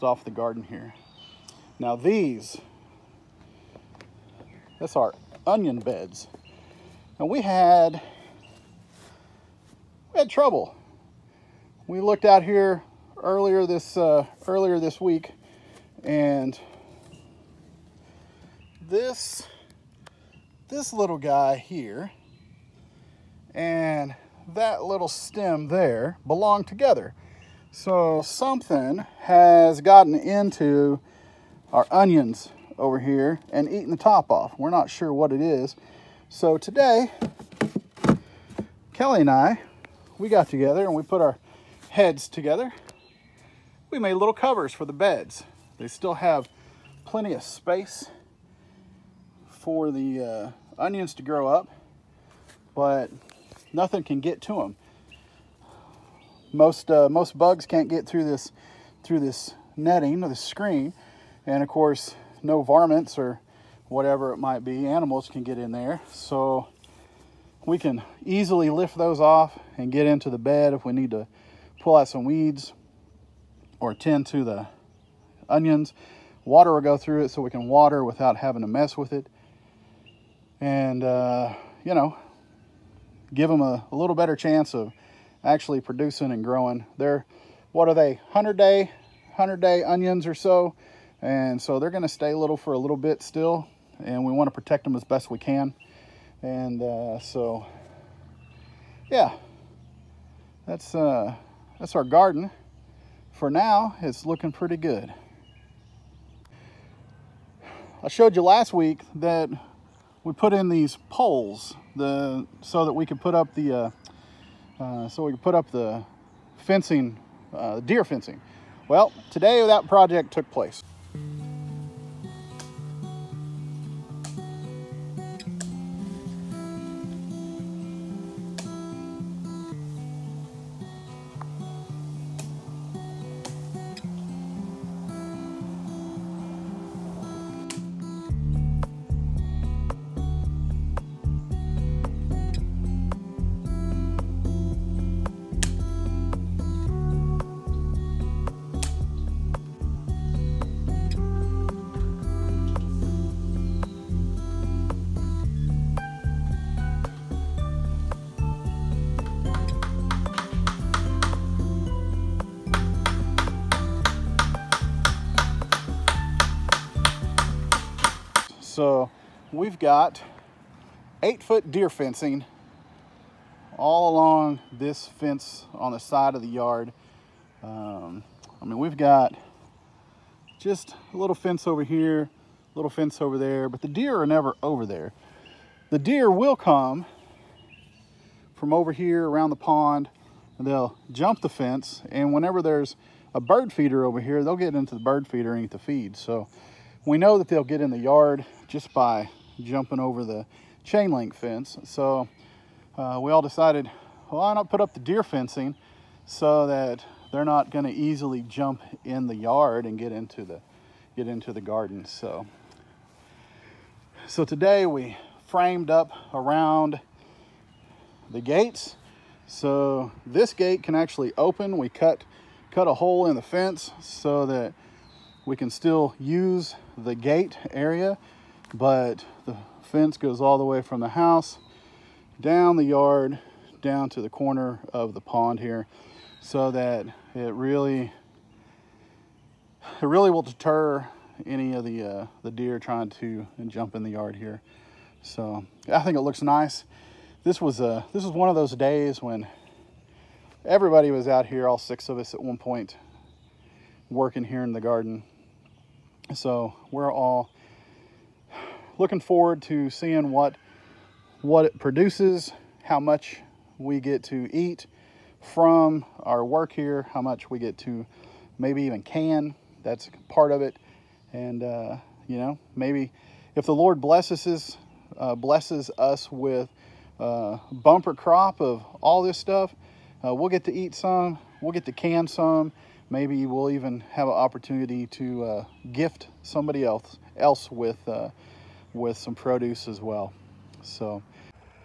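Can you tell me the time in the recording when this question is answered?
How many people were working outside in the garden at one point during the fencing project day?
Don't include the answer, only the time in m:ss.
4:11.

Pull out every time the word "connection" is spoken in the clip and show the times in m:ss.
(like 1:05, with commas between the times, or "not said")
not said.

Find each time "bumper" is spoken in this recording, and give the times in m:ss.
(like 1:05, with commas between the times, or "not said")
4:37.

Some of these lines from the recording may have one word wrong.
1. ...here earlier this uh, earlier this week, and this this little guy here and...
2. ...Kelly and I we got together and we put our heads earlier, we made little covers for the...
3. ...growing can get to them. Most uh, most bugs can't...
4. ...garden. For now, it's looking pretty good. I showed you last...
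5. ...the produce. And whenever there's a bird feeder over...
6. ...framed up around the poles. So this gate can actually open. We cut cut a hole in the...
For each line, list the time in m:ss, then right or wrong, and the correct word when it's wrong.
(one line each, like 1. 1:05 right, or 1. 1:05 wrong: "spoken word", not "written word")
1. 0:12 right
2. 0:38 wrong: "together", not "earlier"
3. 0:53 wrong: "nothing", not "growing"
4. 1:42 right
5. 3:11 wrong: "fence", not "produce"
6. 3:35 wrong: "gates", not "poles".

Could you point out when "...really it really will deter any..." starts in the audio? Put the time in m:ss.
3:57.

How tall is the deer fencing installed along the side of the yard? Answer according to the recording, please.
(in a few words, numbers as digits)
8 feet.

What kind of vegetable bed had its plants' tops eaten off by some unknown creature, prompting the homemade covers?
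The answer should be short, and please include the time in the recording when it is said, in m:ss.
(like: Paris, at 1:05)
Onion, at 0:05.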